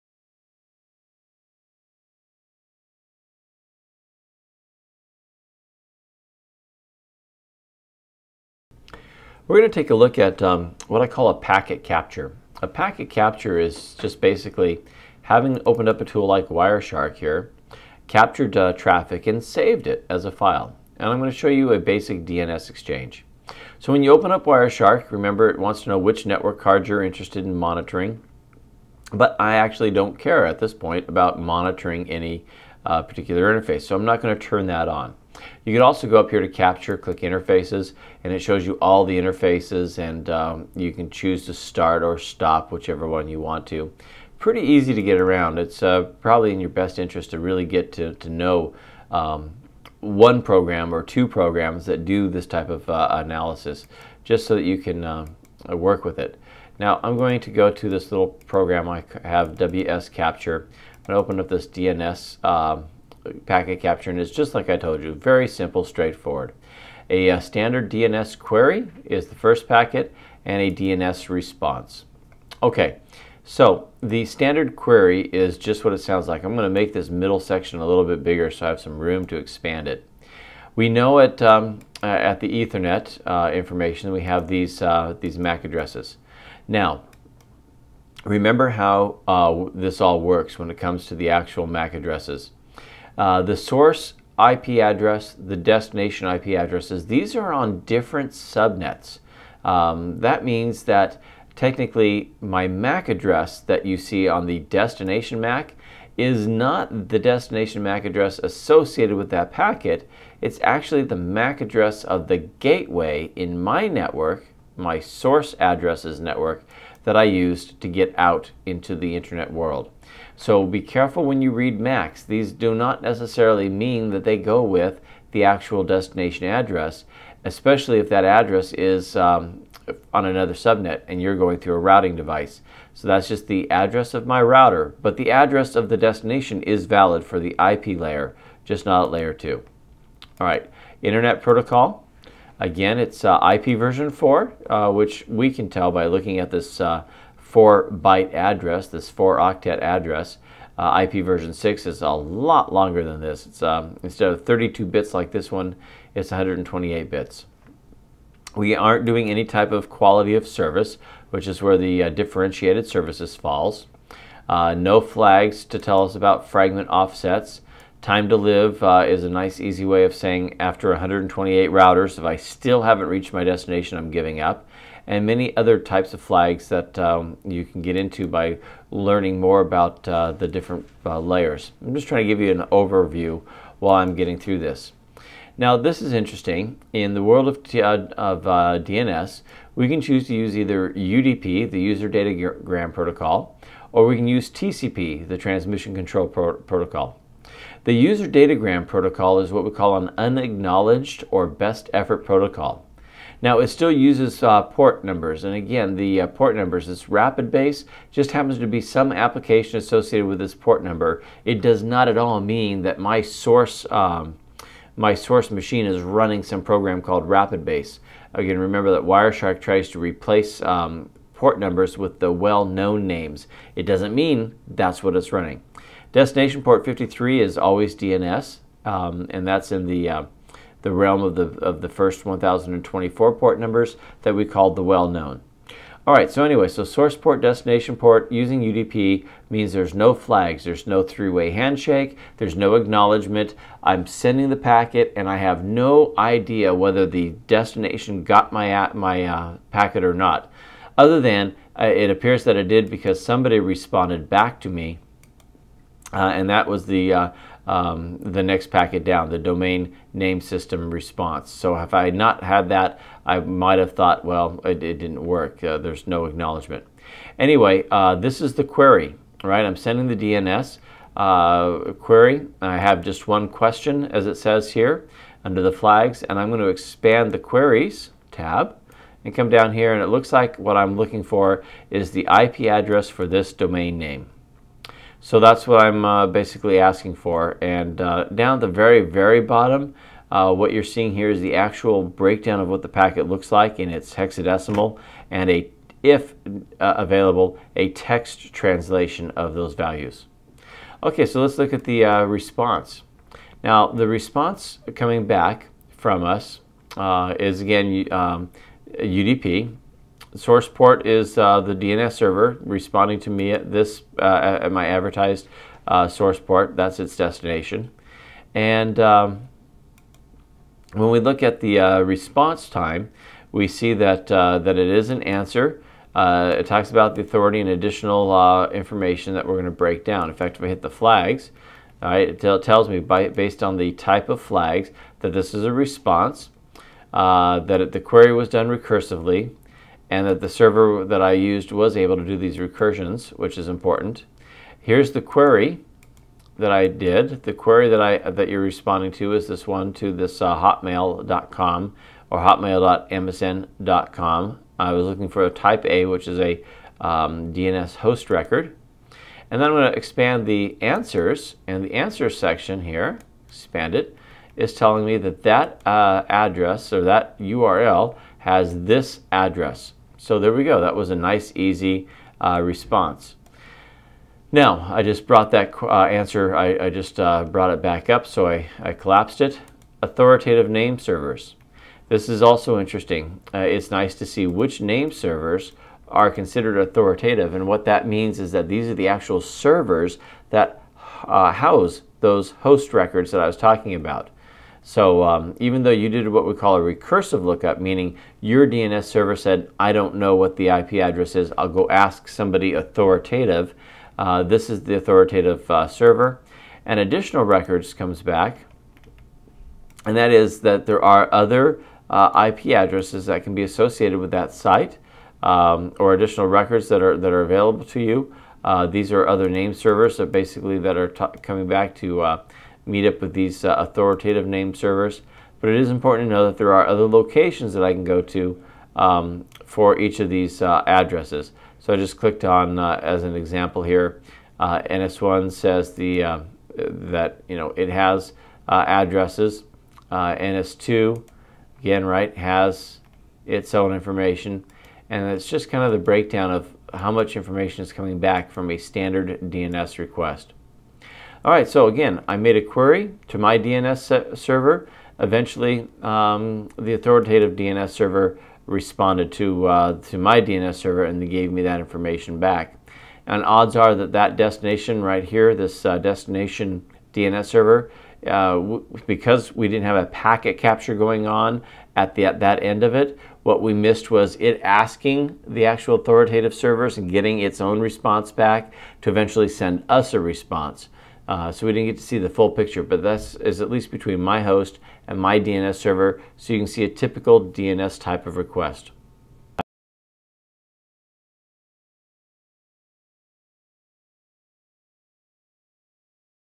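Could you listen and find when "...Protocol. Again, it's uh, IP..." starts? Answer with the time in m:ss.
2:21.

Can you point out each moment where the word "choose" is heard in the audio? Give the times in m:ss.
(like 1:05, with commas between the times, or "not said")
0:41, 3:10.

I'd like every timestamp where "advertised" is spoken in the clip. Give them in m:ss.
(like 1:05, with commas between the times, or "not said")
5:14.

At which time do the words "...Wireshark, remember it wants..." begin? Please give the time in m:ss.
0:24.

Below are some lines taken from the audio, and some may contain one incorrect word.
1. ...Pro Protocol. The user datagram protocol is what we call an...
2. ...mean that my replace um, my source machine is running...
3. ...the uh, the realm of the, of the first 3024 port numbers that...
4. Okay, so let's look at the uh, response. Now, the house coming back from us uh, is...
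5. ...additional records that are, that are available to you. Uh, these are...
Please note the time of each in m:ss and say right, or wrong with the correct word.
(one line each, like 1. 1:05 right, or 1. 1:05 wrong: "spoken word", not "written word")
1. 3:16 right
2. 3:32 wrong: "source", not "replace"
3. 3:49 wrong: "1024", not "3024"
4. 5:01 wrong: "response", not "house"
5. 6:56 right.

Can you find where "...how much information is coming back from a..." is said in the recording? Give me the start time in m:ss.
7:26.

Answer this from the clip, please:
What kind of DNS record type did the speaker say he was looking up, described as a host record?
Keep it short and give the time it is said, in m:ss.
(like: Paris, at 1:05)
type A, at 5:55.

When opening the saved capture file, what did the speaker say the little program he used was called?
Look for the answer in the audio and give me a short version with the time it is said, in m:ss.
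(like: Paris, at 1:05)
WS Capture, at 0:59.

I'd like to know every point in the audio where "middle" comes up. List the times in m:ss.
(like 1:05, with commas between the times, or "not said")
1:17.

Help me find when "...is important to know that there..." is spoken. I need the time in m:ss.
7:05.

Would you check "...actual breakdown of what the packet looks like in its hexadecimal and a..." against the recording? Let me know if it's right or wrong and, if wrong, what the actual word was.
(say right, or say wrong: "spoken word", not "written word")
right.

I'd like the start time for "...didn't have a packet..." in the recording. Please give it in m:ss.
7:49.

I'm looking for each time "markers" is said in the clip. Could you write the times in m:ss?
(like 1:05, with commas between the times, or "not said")
not said.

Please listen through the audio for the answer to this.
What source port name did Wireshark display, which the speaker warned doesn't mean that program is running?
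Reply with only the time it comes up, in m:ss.
3:27.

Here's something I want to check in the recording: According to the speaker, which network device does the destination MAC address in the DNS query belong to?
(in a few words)
the gateway.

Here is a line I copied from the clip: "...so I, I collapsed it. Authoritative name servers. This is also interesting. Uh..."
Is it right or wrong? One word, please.
right.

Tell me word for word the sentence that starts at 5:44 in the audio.
Here's the query that I did.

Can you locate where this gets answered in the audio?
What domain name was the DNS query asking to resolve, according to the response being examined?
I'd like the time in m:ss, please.
5:52.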